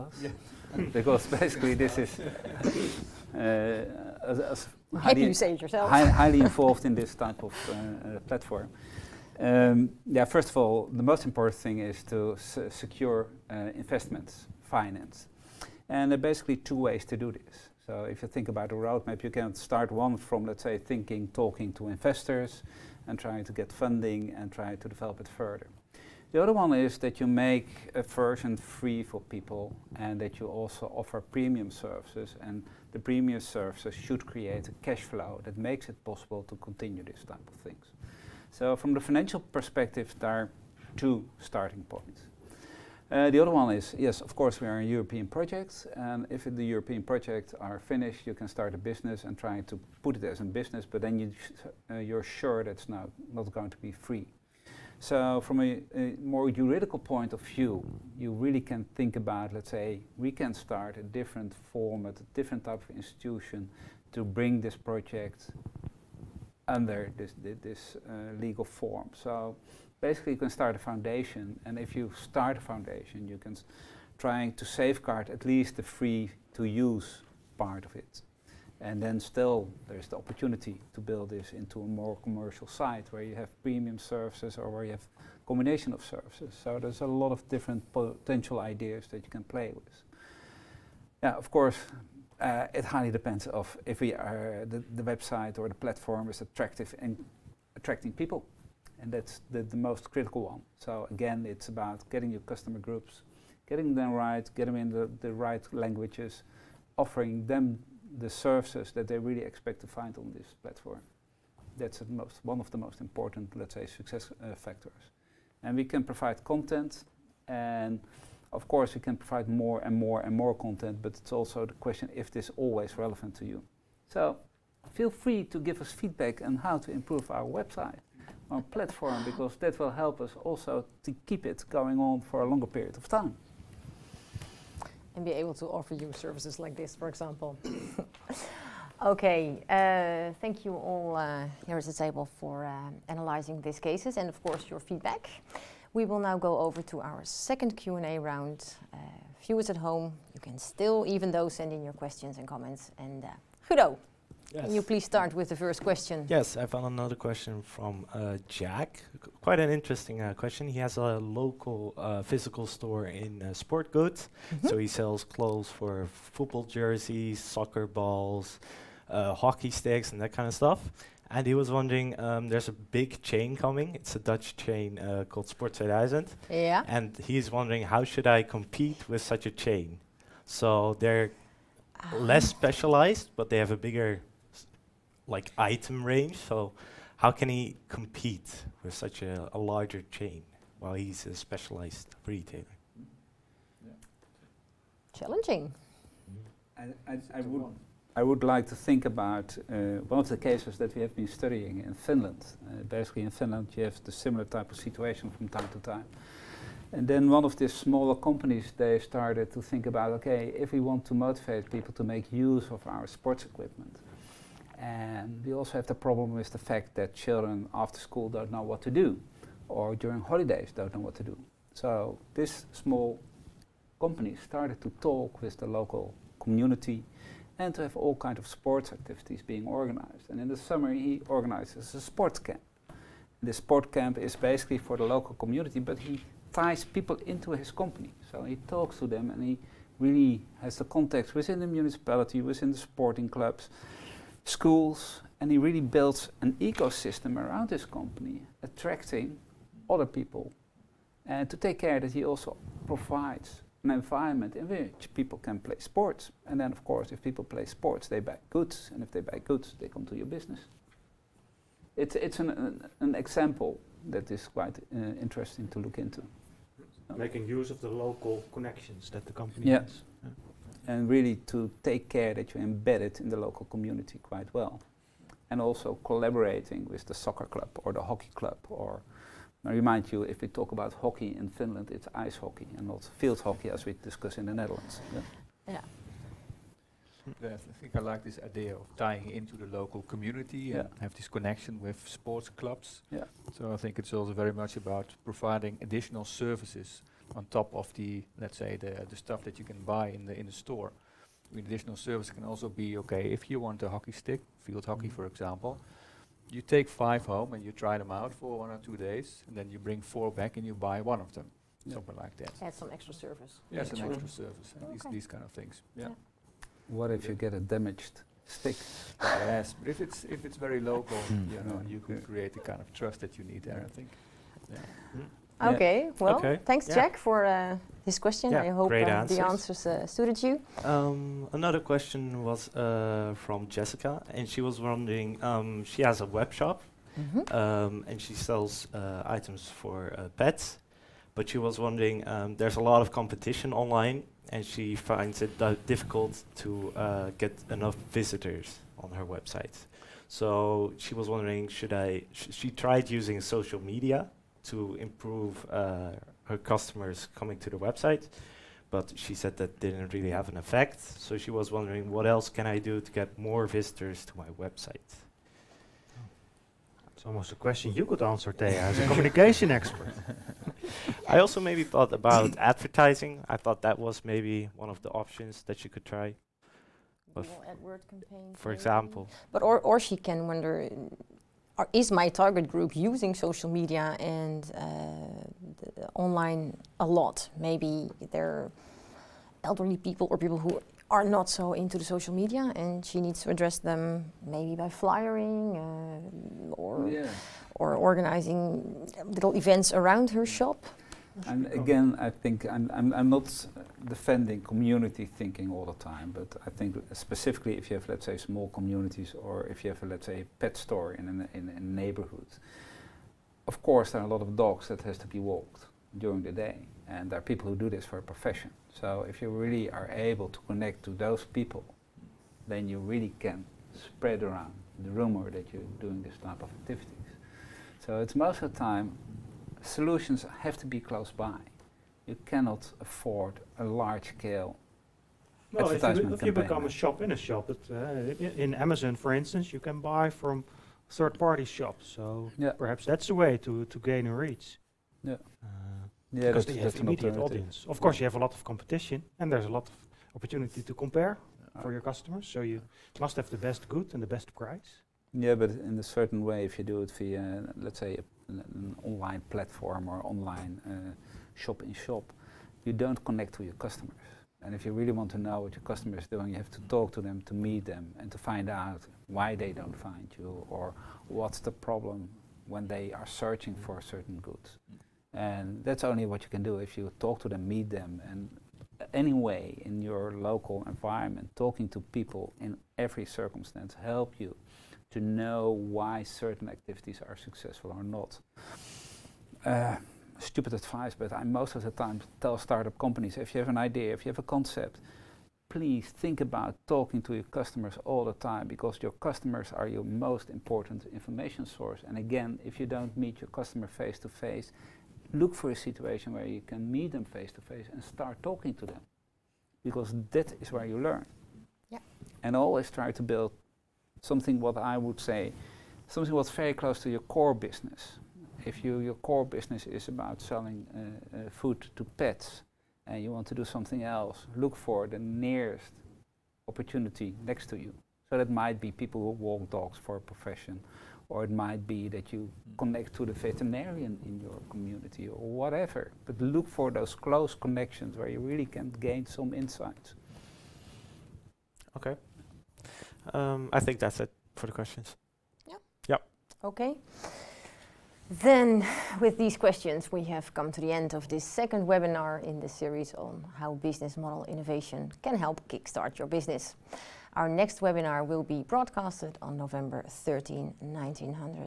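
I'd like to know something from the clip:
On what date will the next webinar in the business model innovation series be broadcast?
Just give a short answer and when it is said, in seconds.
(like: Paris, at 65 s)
November 13, at 559 s.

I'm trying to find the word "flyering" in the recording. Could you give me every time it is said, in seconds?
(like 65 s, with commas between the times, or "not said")
394 s.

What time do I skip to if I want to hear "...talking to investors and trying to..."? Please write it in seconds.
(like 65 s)
21 s.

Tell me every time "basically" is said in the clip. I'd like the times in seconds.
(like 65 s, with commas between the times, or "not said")
1 s, 16 s, 70 s, 202 s, 234 s.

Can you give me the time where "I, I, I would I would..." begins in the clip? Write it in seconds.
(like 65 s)
197 s.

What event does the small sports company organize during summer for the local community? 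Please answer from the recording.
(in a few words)
A sports camp.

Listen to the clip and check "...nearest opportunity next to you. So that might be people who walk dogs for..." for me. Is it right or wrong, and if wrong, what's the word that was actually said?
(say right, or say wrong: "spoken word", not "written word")
right.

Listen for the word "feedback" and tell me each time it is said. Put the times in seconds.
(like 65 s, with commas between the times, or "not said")
125 s, 144 s.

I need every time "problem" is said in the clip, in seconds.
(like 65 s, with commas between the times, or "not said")
215 s, 471 s.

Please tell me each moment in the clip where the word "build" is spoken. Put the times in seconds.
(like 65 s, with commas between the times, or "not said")
81 s, 245 s, 513 s.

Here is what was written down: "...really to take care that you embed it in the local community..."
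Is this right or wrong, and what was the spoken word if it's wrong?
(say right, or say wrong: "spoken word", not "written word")
right.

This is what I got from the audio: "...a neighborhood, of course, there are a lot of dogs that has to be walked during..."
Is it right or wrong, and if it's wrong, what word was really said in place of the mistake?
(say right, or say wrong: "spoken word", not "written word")
right.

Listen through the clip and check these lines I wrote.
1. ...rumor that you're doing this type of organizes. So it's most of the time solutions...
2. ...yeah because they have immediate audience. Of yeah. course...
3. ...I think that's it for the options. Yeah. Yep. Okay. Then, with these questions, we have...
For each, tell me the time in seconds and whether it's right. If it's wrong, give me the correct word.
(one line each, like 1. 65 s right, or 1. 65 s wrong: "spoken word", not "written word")
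1. 425 s wrong: "activities", not "organizes"
2. 446 s right
3. 543 s wrong: "questions", not "options".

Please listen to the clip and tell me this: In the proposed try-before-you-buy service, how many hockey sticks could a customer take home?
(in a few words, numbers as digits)
5.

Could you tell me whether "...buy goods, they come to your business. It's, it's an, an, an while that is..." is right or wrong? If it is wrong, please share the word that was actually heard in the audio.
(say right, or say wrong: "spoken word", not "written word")
wrong: "example", not "while".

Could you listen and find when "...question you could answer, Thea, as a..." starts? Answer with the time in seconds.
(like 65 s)
367 s.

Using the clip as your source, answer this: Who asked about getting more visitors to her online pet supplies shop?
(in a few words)
Jessica.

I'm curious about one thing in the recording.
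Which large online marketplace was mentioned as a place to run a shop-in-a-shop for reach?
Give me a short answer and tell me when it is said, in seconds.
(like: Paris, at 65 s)
Amazon, at 438 s.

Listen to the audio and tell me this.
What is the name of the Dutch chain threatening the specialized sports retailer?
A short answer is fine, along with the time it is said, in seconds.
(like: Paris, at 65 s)
Sport 2000, at 175 s.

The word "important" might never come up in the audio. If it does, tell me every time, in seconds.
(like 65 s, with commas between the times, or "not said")
11 s, 113 s, 500 s.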